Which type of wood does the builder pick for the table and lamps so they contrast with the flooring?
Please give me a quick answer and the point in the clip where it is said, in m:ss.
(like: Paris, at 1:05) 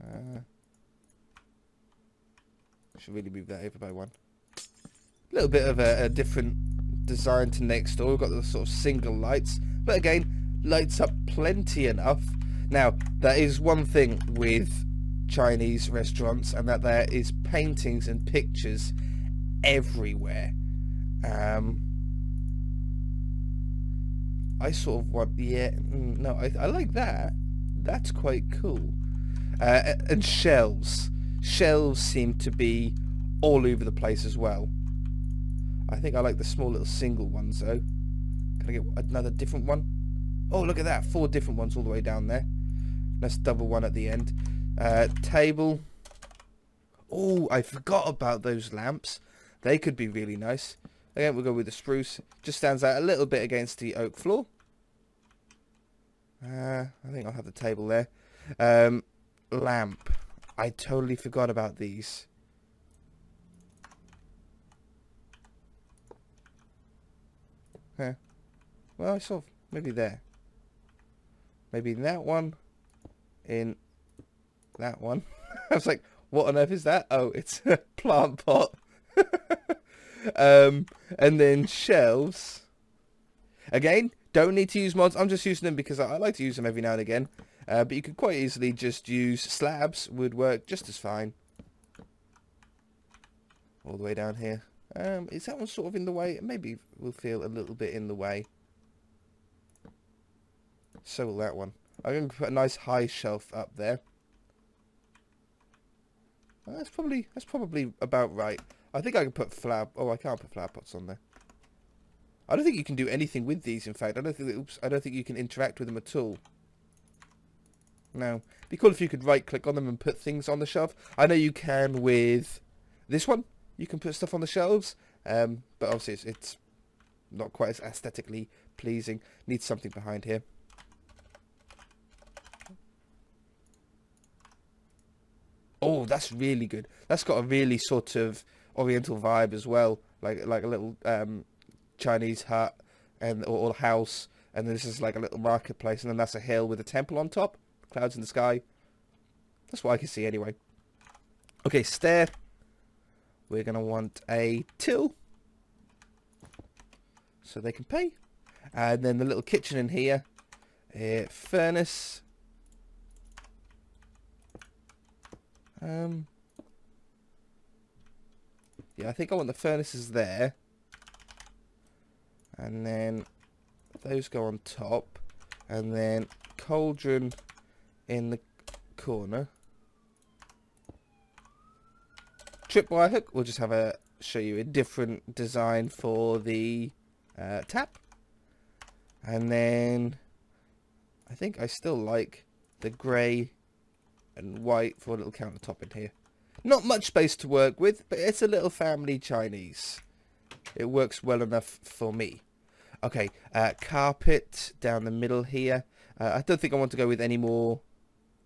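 Spruce, at 0:51.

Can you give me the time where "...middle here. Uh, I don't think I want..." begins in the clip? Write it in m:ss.
3:25.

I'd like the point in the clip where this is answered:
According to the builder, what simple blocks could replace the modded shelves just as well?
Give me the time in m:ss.
1:29.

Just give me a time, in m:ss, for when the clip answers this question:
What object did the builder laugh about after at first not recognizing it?
1:17.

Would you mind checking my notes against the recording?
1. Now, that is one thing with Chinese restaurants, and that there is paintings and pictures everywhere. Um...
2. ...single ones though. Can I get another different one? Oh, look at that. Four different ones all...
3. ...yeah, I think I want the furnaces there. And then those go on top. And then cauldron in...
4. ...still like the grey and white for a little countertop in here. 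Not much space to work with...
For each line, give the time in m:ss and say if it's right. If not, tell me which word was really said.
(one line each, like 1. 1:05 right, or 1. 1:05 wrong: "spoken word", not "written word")
1. 0:12 right
2. 0:36 right
3. 2:48 right
4. 3:11 right.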